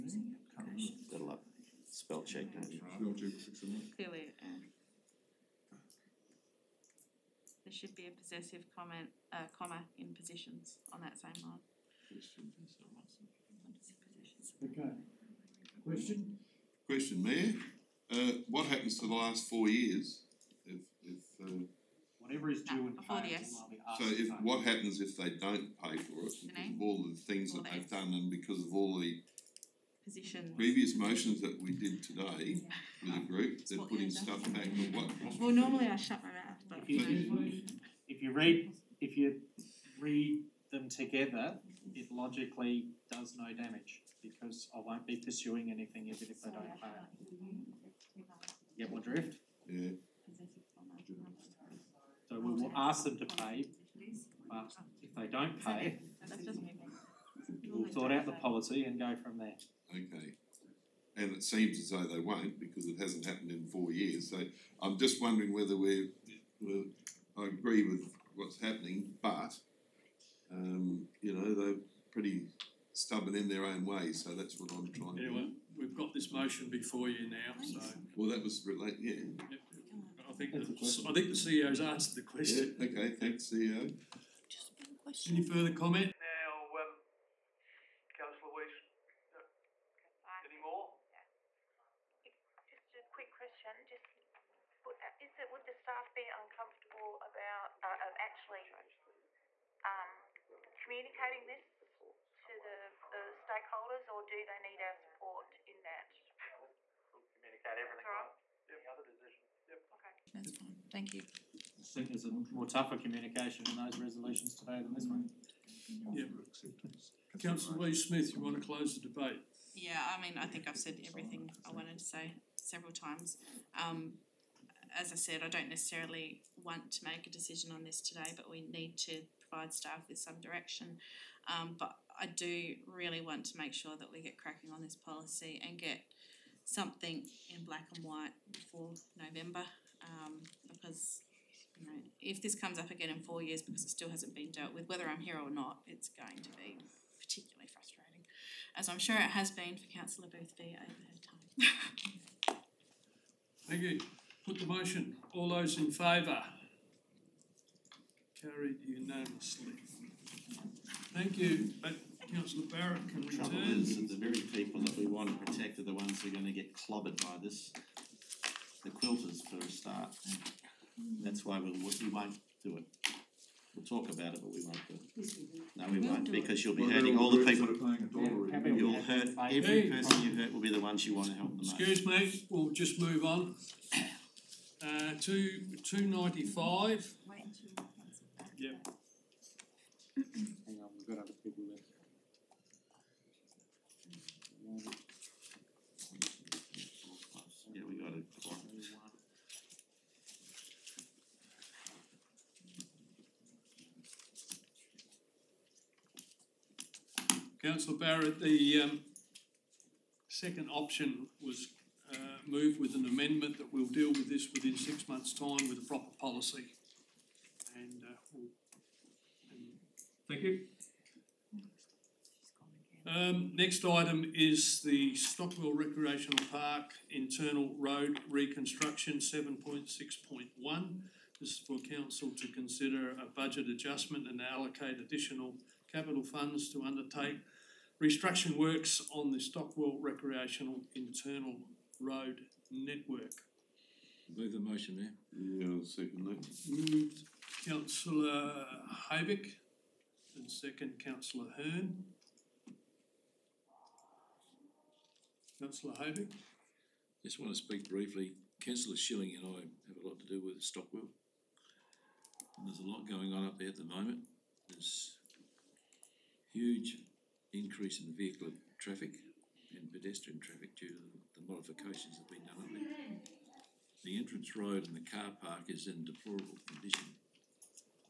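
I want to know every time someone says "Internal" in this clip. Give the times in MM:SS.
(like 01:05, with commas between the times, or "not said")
03:47, 04:00.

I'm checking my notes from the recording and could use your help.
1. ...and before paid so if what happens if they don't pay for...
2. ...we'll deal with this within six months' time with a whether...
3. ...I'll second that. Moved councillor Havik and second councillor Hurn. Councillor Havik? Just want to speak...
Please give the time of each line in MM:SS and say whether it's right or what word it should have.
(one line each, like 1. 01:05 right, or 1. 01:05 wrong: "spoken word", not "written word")
1. 00:22 right
2. 03:33 wrong: "proper", not "whether"
3. 04:05 right.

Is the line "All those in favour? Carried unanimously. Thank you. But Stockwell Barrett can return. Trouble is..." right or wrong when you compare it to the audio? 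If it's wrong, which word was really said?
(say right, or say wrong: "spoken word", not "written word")
wrong: "Councillor", not "Stockwell".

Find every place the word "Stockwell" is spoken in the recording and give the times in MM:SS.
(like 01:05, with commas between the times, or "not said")
03:45, 03:59, 04:20.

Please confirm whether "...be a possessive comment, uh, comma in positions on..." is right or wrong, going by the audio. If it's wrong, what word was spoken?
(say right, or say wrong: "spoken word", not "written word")
right.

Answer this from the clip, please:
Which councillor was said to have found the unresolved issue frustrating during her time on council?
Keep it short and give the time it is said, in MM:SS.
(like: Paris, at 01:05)
Councillor Boothby, at 02:29.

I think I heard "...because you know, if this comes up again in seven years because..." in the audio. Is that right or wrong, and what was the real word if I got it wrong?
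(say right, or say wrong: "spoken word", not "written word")
wrong: "four", not "seven".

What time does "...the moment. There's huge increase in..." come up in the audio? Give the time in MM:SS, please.
04:23.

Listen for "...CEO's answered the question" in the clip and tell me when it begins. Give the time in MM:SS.
01:21.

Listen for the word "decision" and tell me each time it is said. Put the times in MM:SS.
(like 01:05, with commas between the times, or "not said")
01:49, 02:07.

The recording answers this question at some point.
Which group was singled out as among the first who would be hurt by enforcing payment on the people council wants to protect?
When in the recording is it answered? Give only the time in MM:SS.
02:48.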